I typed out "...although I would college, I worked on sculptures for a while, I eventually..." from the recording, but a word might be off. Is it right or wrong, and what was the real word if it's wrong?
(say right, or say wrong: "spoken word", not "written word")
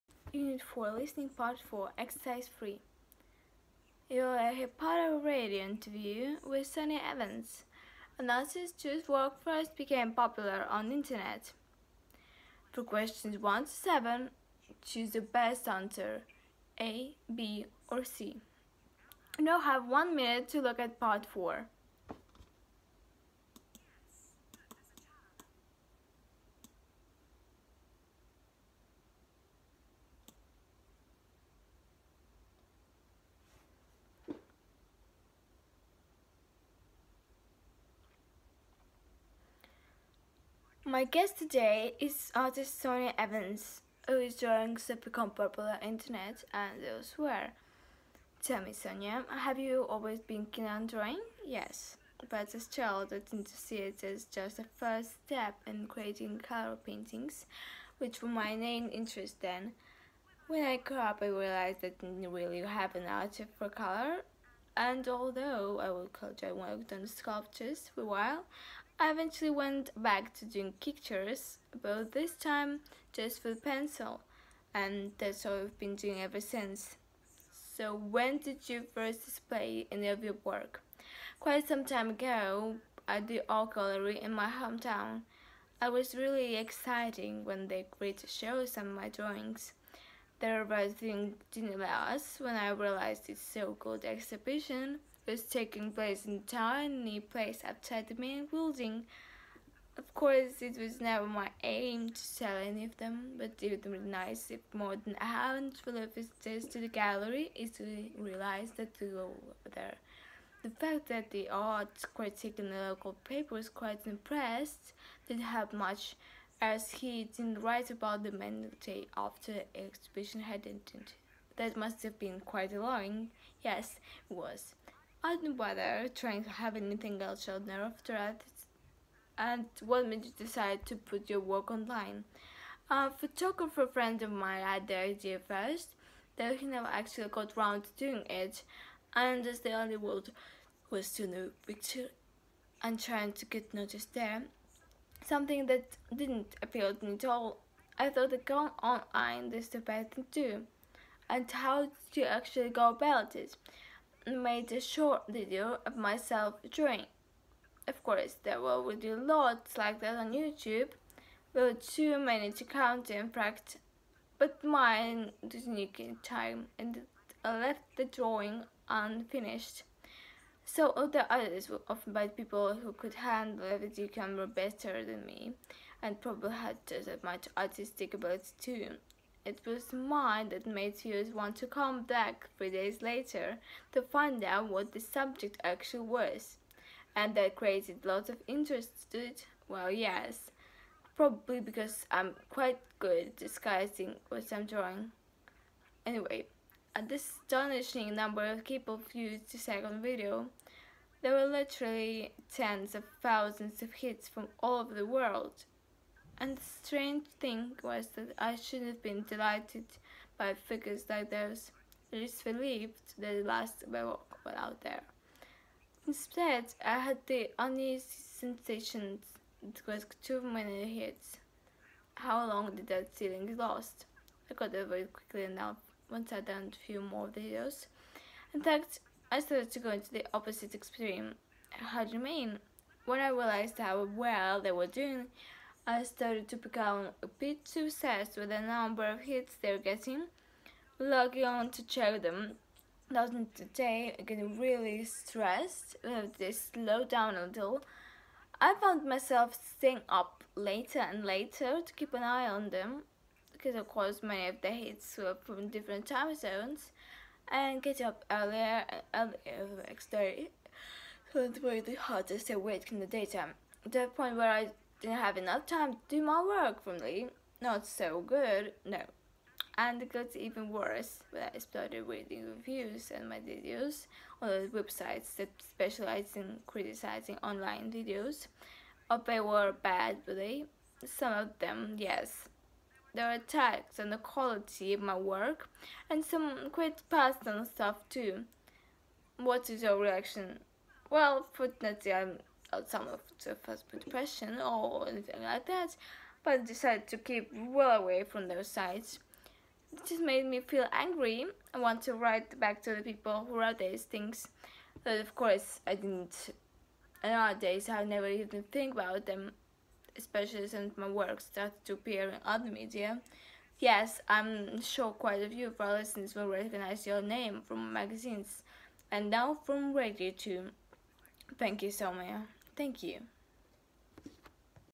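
right.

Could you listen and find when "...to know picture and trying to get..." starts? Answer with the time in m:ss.
2:21.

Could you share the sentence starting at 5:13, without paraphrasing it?
Yes, I'm sure quite a few of our listeners will recognize your name from magazines and now from radio too.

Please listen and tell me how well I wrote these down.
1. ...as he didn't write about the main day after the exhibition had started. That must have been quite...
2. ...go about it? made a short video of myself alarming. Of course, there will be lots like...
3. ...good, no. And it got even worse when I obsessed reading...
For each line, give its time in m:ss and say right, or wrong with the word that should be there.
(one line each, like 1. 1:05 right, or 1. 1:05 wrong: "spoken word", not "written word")
1. 1:56 wrong: "ended", not "started"
2. 2:32 wrong: "drawing", not "alarming"
3. 4:28 wrong: "started", not "obsessed".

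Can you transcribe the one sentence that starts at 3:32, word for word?
least relieved that at last my walk was out there.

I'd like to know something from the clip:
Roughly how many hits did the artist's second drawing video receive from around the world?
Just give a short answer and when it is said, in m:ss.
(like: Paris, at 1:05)
tens of thousands, at 3:22.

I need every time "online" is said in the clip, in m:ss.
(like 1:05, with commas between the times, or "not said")
2:11, 2:28, 4:37.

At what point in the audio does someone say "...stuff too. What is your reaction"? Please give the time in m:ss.
4:47.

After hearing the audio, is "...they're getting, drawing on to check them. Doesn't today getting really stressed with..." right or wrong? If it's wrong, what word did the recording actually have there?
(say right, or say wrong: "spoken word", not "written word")
wrong: "logging", not "drawing".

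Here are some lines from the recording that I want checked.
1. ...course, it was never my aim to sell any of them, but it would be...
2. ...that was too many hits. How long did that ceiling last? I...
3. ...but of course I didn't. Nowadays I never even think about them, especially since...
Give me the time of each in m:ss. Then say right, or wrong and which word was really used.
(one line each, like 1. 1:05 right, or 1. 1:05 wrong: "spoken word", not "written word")
1. 1:40 right
2. 3:39 right
3. 5:05 right.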